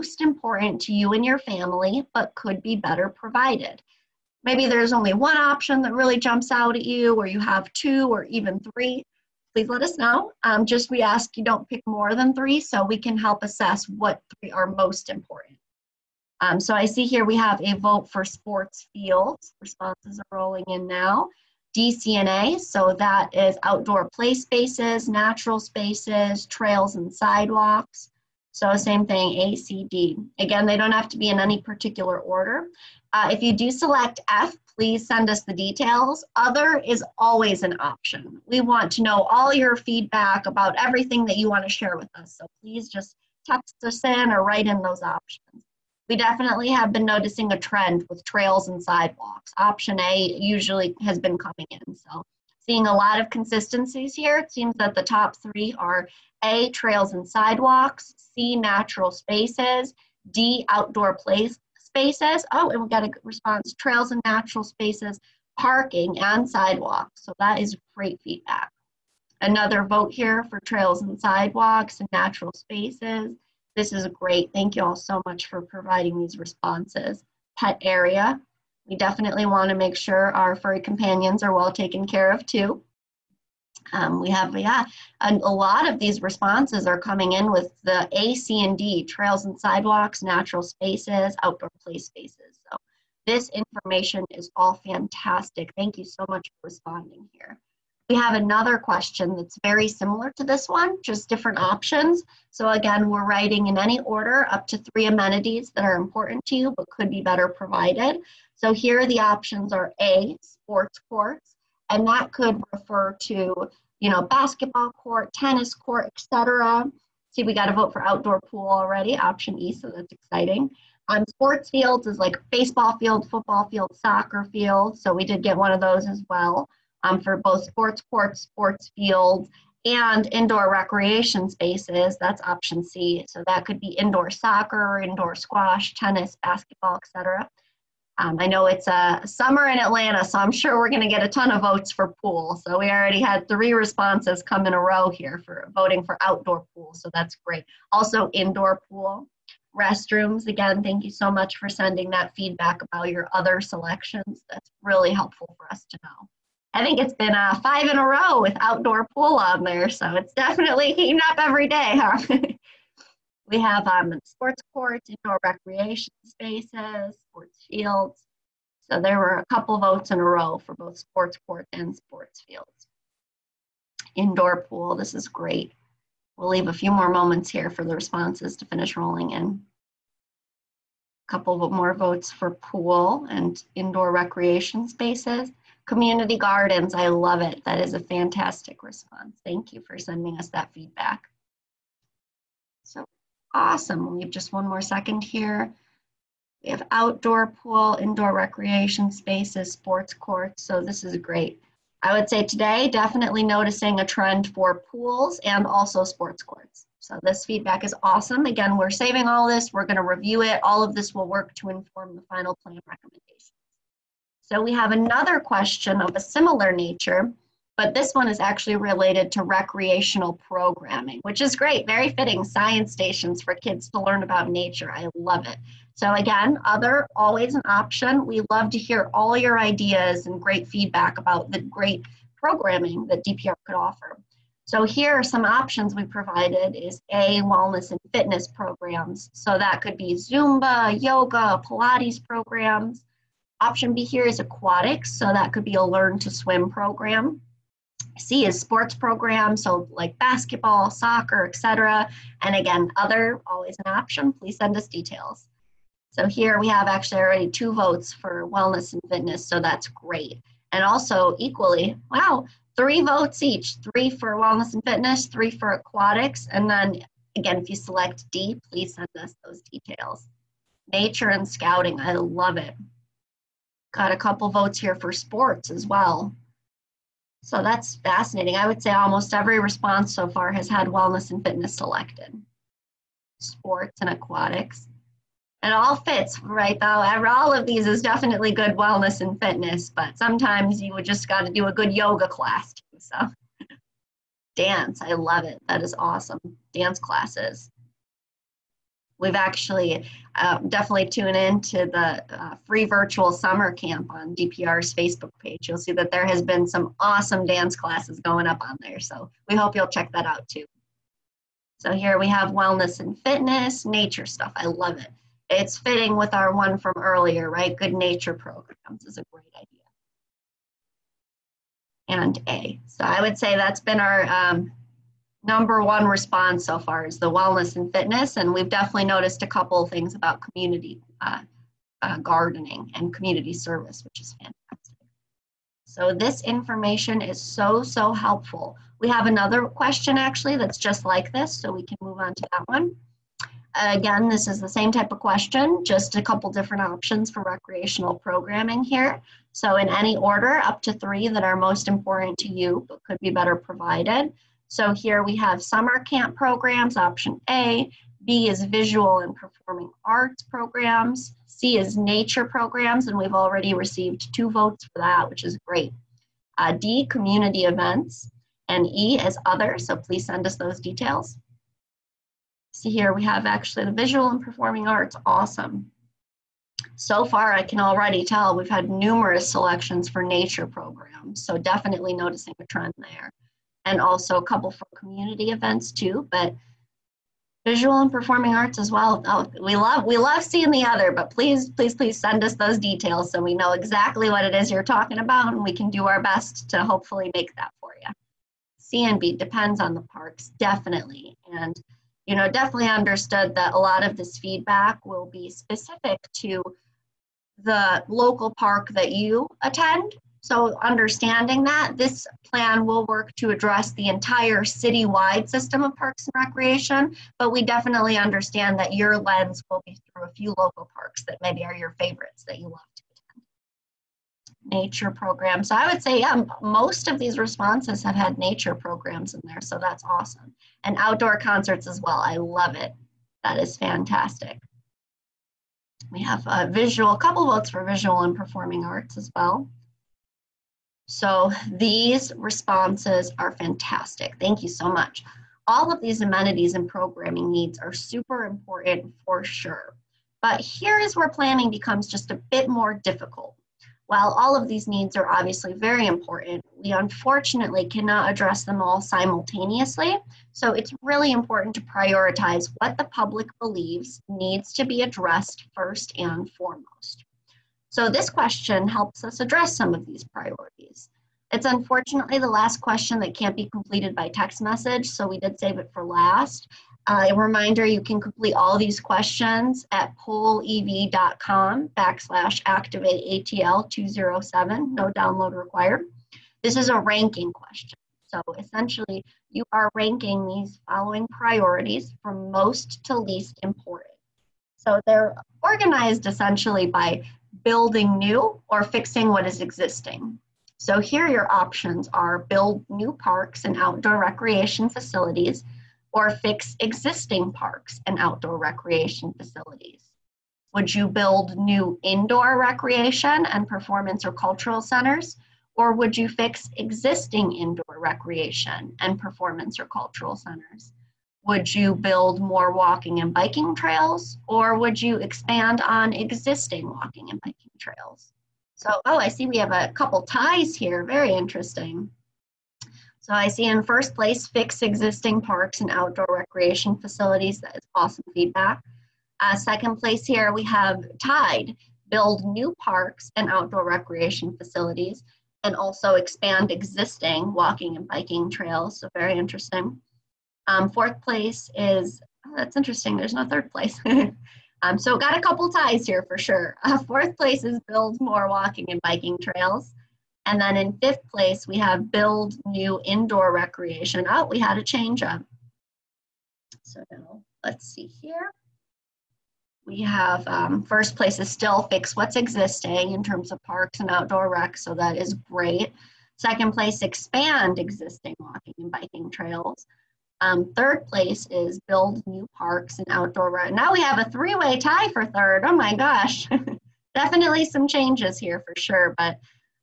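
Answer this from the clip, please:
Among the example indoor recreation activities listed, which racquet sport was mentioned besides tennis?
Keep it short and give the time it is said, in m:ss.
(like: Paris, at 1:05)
Squash, at 2:15.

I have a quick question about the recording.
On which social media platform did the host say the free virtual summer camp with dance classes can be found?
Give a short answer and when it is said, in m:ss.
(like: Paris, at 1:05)
Facebook, at 5:04.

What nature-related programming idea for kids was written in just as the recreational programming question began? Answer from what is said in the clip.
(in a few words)
Science stations.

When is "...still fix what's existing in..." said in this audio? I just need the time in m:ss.
9:31.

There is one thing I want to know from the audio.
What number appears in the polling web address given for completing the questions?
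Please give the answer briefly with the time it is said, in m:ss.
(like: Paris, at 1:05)
207, at 8:03.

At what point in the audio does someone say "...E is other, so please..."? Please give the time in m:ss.
6:08.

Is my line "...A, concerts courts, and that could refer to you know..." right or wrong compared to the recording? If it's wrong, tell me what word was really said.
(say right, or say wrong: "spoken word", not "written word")
wrong: "sports", not "concerts".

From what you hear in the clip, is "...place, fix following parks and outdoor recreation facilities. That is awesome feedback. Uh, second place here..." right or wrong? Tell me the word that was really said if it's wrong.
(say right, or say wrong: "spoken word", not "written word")
wrong: "existing", not "following".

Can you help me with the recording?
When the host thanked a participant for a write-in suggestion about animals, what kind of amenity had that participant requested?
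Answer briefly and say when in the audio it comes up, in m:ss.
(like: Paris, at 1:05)
Pet area, at 1:17.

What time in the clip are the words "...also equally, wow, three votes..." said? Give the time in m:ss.
4:20.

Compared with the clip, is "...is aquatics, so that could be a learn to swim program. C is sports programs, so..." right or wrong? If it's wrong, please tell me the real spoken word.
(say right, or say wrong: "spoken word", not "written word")
right.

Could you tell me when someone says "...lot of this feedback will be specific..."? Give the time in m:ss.
6:43.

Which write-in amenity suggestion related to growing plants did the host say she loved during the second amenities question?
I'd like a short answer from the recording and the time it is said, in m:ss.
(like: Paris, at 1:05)
Community gardens, at 3:05.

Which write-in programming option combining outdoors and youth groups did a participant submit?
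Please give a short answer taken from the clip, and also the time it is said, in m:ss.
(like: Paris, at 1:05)
Nature and scouting, at 4:30.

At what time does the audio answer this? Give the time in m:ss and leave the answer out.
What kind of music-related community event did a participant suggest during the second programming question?
7:10.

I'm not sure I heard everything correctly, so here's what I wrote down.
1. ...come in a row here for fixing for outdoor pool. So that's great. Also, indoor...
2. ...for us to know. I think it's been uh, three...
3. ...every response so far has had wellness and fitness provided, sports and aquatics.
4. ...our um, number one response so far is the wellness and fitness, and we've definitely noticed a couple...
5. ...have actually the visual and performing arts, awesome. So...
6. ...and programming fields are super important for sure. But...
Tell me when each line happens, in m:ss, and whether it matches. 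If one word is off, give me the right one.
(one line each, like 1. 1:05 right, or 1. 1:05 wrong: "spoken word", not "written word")
1. 2:24 wrong: "voting", not "fixing"
2. 2:35 wrong: "five", not "three"
3. 4:39 wrong: "selected", not "provided"
4. 5:23 right
5. 6:13 right
6. 7:26 wrong: "needs", not "fields".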